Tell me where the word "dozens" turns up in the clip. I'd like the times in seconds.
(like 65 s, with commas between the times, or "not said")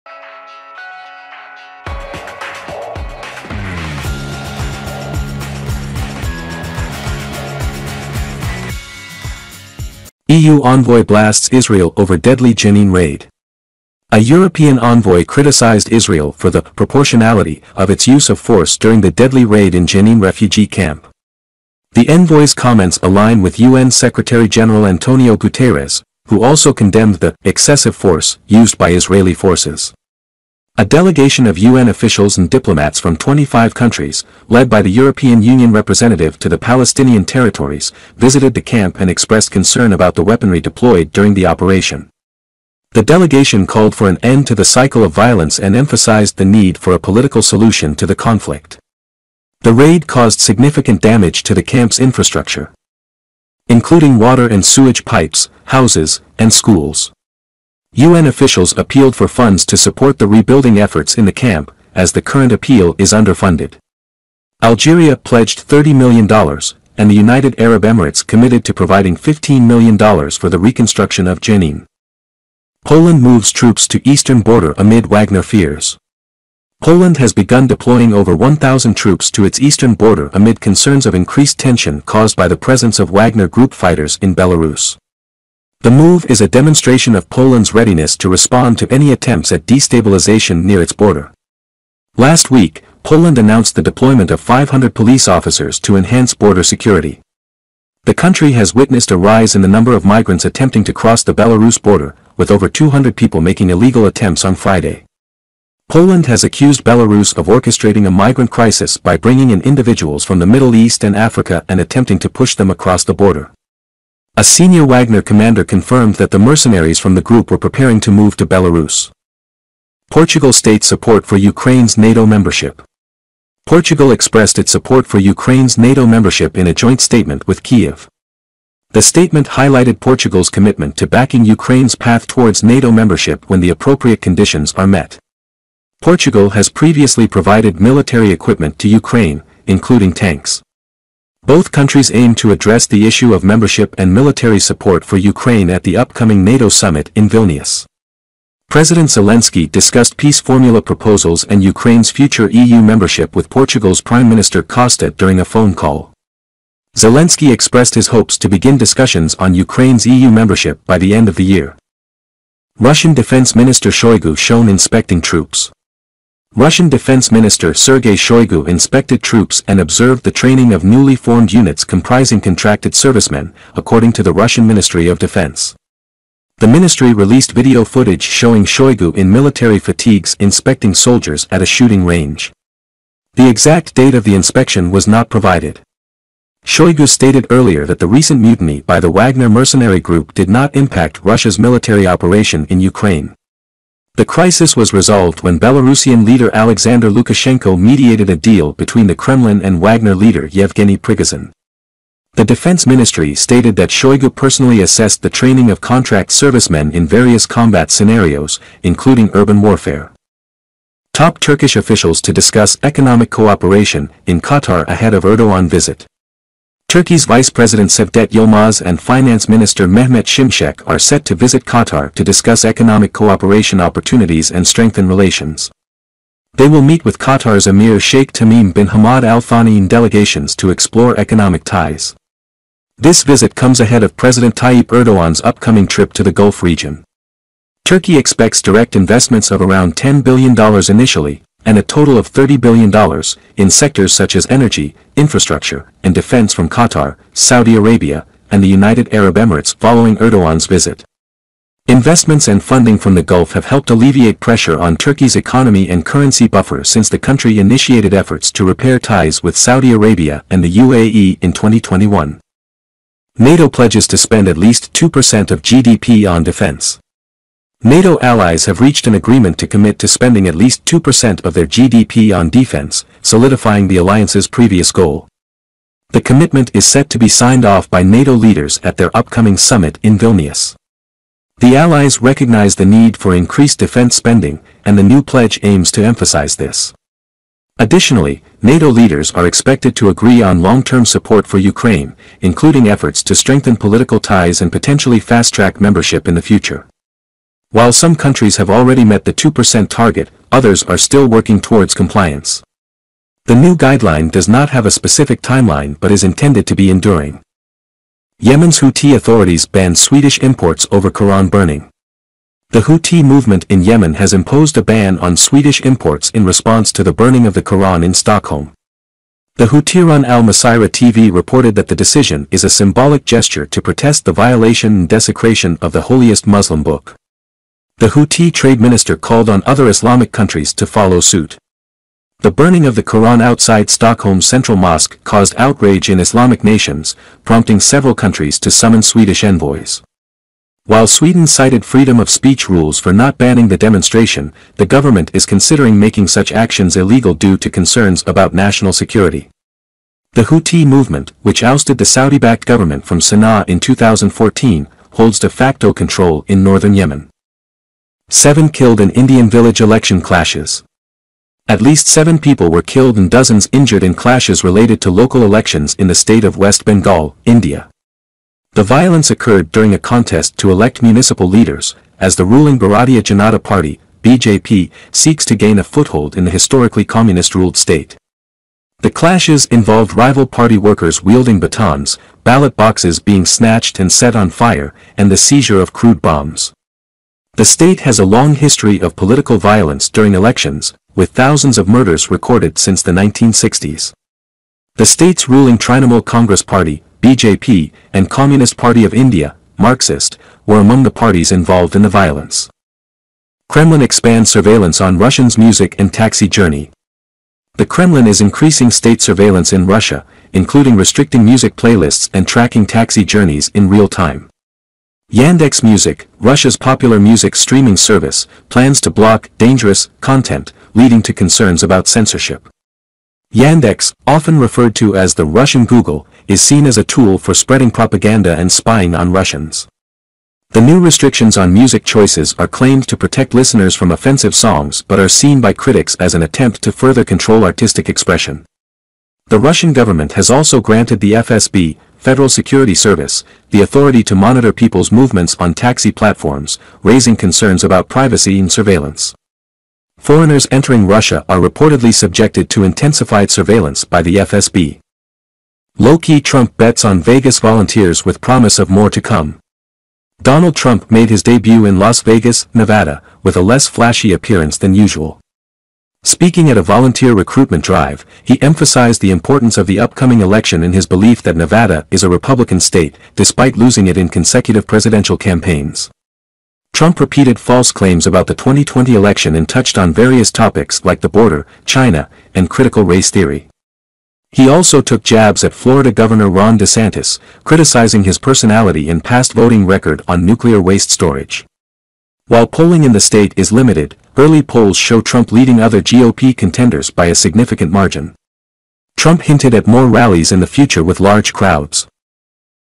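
363 s.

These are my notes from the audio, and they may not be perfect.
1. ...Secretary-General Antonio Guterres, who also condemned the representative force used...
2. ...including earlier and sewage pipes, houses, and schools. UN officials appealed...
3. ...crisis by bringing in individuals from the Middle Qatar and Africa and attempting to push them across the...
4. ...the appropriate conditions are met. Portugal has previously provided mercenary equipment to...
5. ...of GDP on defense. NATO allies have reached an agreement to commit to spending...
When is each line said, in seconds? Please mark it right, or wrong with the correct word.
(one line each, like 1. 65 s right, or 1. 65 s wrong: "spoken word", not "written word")
1. 23 s wrong: "excessive", not "representative"
2. 53 s wrong: "water", not "earlier"
3. 108 s wrong: "East", not "Qatar"
4. 133 s wrong: "military", not "mercenary"
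5. 265 s right.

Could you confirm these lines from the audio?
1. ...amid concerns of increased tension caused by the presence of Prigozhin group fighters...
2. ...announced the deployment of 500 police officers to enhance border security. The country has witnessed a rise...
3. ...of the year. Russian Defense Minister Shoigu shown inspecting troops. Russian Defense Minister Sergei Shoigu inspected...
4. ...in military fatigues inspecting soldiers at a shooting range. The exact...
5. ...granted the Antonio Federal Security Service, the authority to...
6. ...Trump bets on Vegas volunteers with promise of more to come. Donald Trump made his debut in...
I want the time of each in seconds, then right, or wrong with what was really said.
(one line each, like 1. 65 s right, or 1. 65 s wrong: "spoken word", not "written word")
1. 80 s wrong: "Wagner", not "Prigozhin"
2. 93 s right
3. 161 s right
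4. 179 s right
5. 440 s wrong: "FSB", not "Antonio"
6. 456 s right.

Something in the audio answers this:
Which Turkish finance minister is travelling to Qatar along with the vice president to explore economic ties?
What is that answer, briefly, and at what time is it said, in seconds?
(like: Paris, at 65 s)
Mehmet Şimşek, at 219 s.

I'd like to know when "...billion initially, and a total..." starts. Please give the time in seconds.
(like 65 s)
240 s.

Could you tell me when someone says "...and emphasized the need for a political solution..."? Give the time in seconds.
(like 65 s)
45 s.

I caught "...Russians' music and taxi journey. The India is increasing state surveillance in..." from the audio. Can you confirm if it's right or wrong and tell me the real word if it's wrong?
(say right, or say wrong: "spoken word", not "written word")
wrong: "Kremlin", not "India".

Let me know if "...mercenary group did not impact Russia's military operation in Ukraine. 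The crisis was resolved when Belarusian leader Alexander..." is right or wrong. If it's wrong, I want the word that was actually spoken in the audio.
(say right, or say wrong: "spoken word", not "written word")
right.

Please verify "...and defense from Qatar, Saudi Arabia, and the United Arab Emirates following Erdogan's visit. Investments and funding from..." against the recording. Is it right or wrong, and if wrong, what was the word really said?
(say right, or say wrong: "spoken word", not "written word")
right.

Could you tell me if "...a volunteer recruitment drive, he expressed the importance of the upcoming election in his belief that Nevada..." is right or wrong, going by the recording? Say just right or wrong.
wrong.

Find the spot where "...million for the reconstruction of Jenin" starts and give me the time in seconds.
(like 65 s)
69 s.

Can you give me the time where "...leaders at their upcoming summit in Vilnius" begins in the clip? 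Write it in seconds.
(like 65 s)
278 s.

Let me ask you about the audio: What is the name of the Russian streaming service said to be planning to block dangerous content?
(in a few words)
Yandex Music.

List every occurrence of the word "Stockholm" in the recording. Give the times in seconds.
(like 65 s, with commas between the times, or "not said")
318 s, 333 s.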